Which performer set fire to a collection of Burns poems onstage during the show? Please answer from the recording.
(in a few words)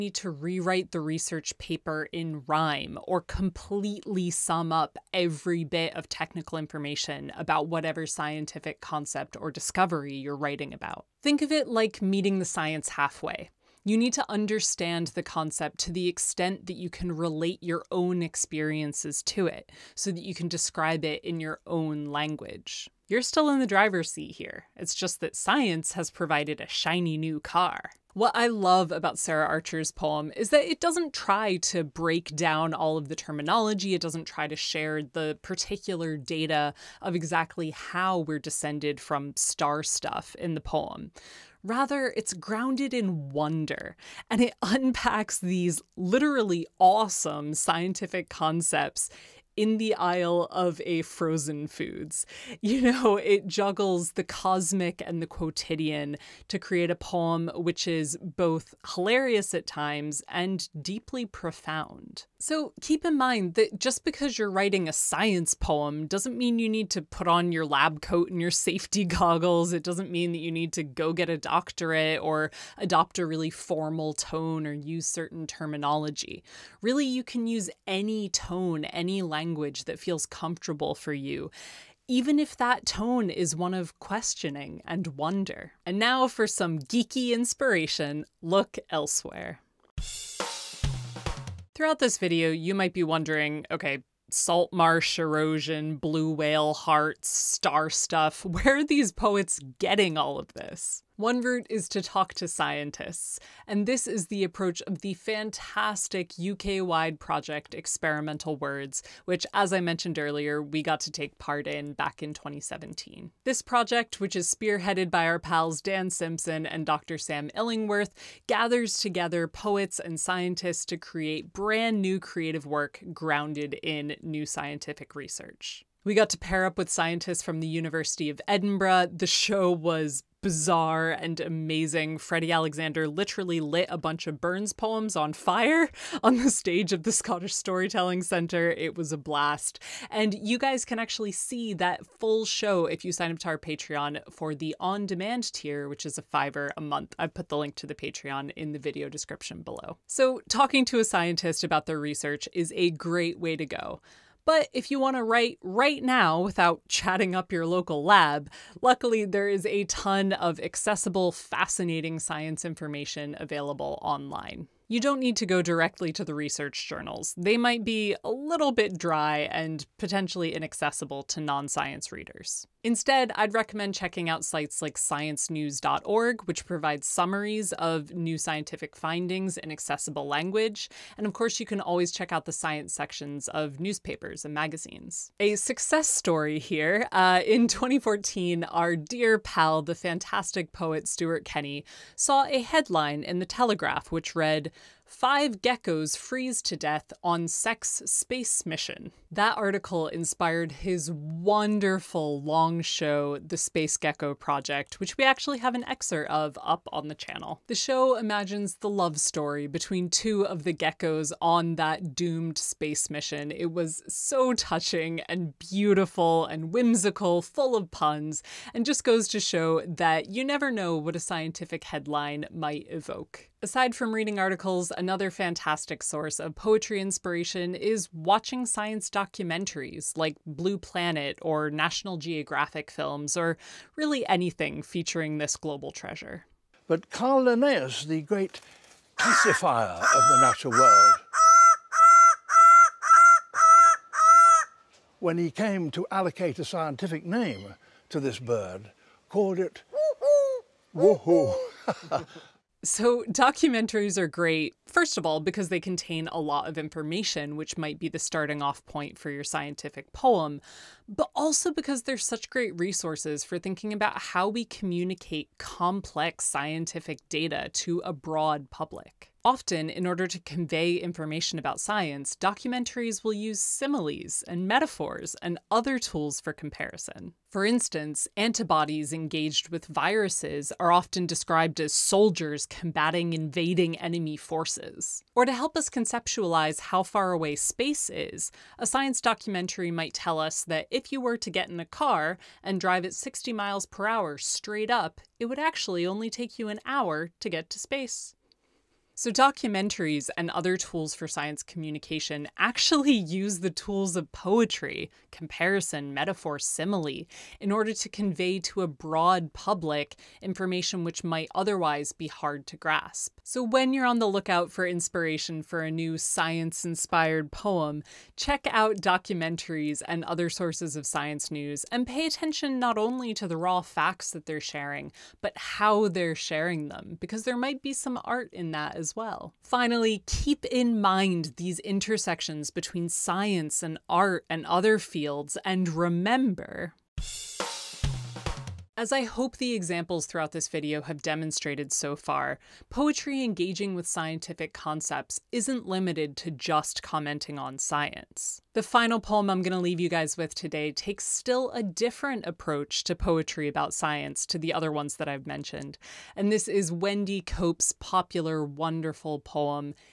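Freddie Alexander.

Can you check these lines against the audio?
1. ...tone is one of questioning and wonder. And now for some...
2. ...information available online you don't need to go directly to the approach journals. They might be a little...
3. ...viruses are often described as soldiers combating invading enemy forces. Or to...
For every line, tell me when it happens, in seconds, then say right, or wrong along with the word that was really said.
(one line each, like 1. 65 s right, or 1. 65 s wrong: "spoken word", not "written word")
1. 82 s right
2. 162 s wrong: "research", not "approach"
3. 279 s right.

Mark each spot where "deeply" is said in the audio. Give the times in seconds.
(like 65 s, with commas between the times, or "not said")
60 s.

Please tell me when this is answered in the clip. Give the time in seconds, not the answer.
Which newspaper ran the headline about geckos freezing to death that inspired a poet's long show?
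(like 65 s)
193 s.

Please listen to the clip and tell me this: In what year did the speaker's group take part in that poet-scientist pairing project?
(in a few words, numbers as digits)
2017.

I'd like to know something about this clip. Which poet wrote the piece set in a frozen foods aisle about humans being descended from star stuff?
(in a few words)
Sarah Archer.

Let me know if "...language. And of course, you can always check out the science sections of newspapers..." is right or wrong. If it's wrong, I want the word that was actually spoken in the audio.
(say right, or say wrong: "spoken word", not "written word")
right.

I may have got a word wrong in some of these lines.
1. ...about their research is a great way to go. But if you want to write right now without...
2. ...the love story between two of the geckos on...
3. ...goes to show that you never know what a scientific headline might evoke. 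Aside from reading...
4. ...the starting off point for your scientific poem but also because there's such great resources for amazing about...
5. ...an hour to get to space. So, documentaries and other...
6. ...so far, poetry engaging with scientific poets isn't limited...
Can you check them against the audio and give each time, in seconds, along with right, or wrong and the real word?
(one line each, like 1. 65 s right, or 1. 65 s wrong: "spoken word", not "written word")
1. 151 s right
2. 208 s right
3. 219 s right
4. 258 s wrong: "thinking", not "amazing"
5. 296 s right
6. 341 s wrong: "concepts", not "poets".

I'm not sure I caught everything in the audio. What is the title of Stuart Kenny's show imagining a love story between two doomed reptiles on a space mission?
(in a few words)
The Space Gecko Project.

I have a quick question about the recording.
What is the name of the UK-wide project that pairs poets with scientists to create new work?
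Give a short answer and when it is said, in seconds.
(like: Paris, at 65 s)
Experimental Words, at 107 s.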